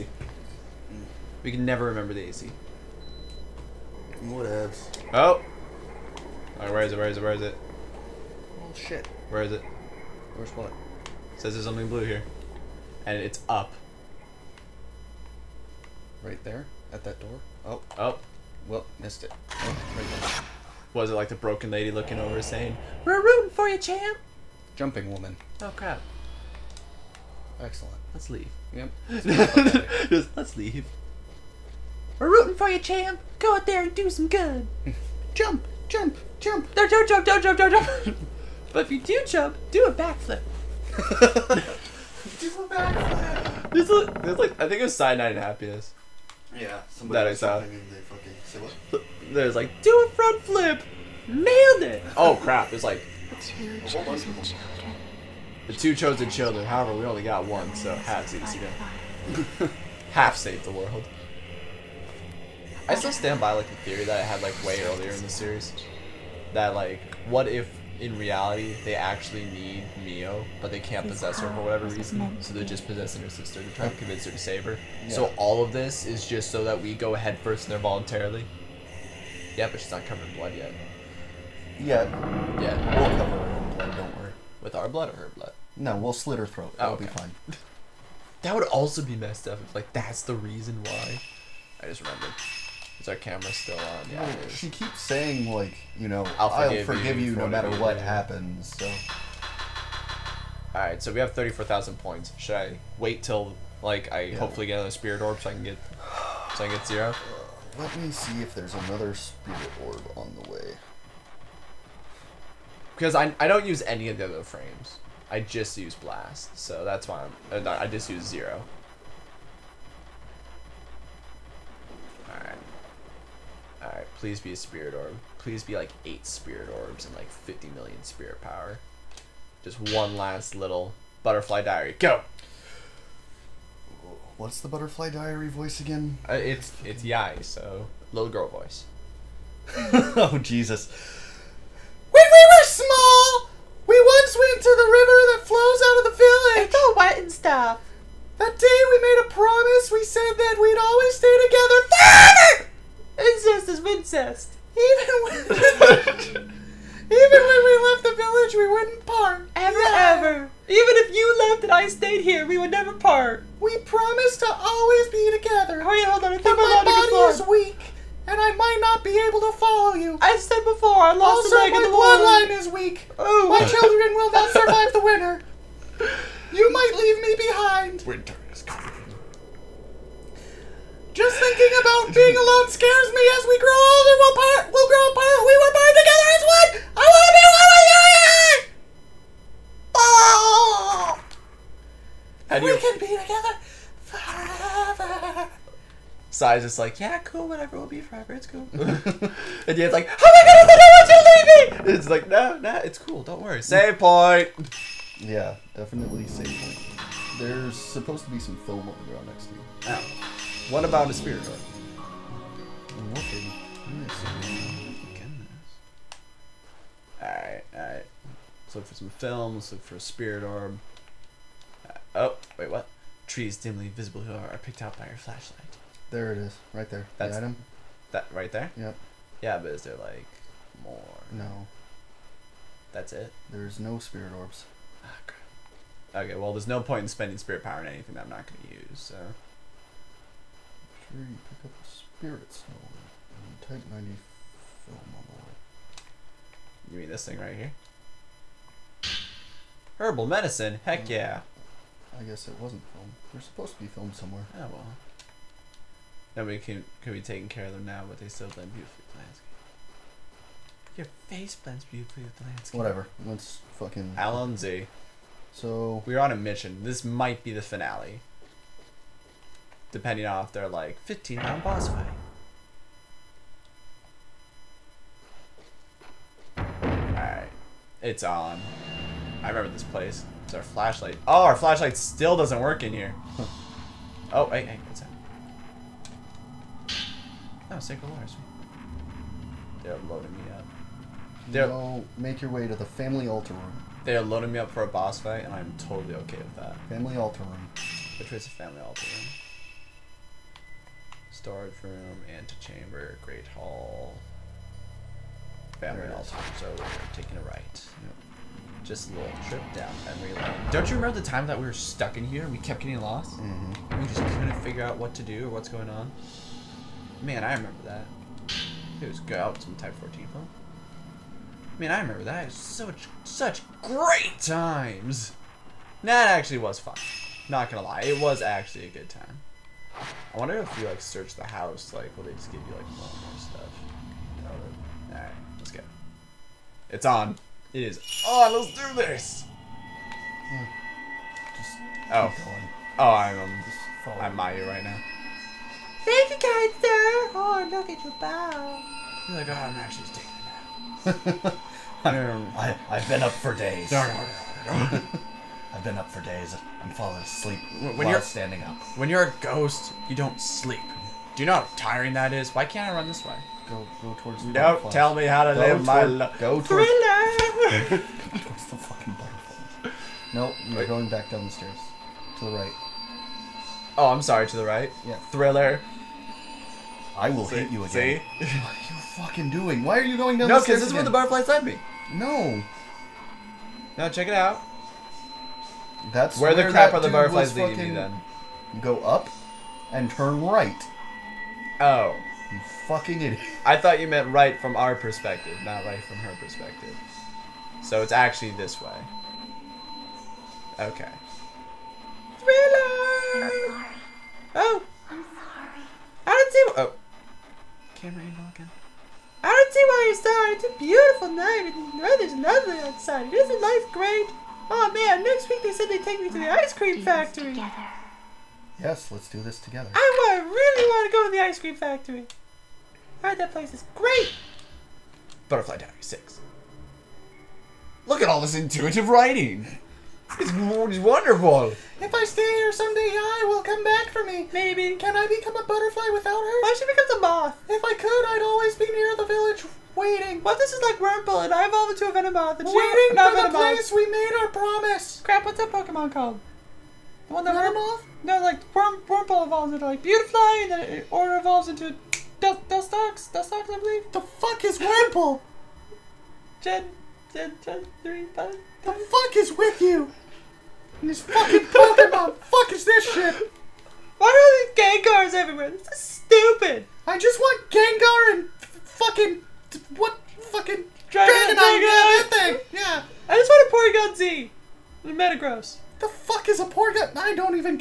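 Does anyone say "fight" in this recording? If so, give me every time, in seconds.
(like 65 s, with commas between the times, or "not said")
271 s, 295 s.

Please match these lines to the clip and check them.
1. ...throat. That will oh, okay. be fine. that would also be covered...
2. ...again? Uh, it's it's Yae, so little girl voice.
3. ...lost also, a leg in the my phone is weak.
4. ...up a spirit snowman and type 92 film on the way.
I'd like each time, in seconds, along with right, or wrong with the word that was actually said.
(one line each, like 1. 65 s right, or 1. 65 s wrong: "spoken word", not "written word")
1. 86 s wrong: "messed", not "covered"
2. 135 s right
3. 171 s wrong: "bloodline", not "phone"
4. 241 s wrong: "90", not "92".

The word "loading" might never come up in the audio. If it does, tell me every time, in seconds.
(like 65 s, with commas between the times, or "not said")
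290 s, 294 s.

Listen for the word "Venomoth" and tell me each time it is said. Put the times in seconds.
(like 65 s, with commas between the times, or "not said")
442 s, 447 s.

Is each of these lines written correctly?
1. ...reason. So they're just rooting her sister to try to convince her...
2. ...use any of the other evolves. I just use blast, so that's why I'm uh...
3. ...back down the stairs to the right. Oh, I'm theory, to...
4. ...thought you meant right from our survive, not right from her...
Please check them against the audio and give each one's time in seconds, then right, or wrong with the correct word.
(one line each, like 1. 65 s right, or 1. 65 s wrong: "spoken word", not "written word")
1. 71 s wrong: "possessing", not "rooting"
2. 113 s wrong: "frames", not "evolves"
3. 371 s wrong: "sorry", not "theory"
4. 393 s wrong: "perspective", not "survive".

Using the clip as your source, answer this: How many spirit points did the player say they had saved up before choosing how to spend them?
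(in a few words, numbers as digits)
34,000.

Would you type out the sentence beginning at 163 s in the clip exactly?
We promised to always be together.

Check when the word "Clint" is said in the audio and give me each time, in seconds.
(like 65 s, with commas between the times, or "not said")
not said.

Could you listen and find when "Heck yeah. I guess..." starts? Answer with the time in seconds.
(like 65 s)
250 s.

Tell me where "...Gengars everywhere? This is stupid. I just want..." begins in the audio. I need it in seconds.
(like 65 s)
465 s.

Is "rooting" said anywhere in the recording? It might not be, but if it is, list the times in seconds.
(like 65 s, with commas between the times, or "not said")
23 s, 32 s.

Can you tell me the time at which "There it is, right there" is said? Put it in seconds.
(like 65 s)
226 s.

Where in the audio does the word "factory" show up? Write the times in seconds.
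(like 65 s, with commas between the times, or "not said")
417 s, 421 s.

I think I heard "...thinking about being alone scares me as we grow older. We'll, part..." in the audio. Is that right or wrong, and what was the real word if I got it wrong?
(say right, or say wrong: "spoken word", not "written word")
right.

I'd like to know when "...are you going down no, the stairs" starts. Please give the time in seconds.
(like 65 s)
379 s.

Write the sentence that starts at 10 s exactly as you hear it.
It says there's something blue here.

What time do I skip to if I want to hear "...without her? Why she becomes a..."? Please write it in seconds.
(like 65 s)
436 s.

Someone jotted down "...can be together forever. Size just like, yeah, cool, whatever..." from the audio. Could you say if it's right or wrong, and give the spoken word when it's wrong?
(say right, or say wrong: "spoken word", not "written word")
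right.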